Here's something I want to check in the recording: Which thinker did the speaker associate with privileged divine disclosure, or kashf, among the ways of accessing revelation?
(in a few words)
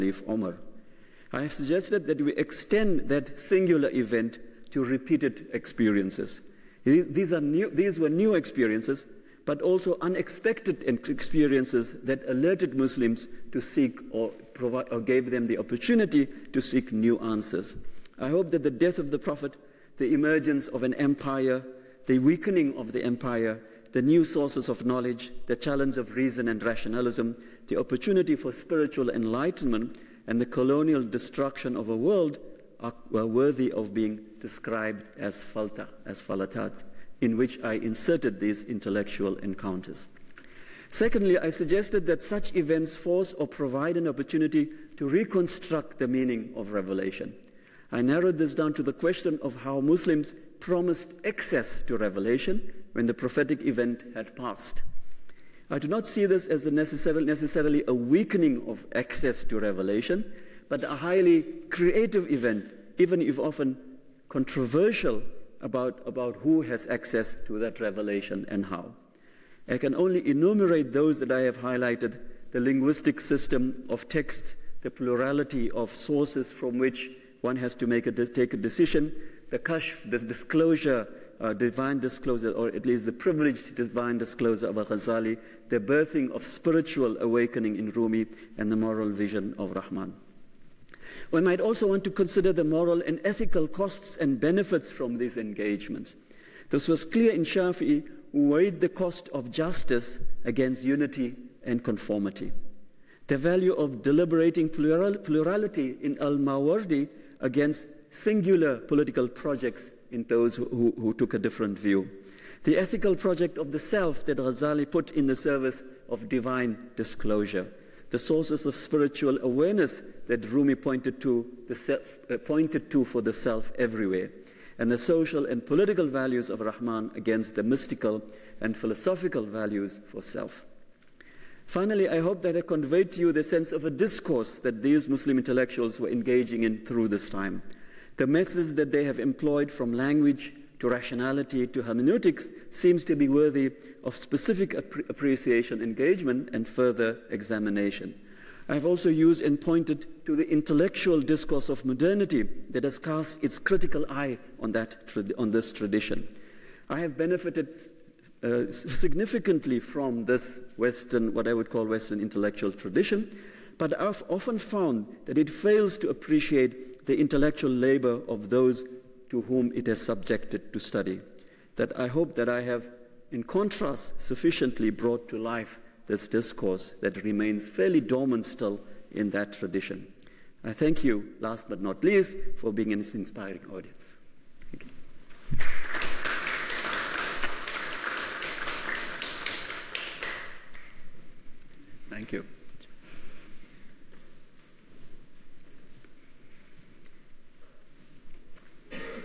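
Al-Ghazali.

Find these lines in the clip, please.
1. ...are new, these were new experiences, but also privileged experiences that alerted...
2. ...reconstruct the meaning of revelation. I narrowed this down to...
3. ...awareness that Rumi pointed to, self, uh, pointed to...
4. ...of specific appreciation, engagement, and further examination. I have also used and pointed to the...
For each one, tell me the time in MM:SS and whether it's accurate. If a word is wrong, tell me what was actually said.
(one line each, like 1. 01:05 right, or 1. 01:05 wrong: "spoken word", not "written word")
1. 00:07 wrong: "unexpected", not "privileged"
2. 00:45 right
3. 01:59 right
4. 02:24 right.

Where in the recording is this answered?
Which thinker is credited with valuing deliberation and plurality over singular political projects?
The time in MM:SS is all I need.
01:46.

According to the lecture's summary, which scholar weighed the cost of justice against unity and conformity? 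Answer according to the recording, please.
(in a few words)
Shafi'i.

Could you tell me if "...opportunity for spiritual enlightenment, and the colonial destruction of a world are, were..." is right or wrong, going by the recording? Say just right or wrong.
right.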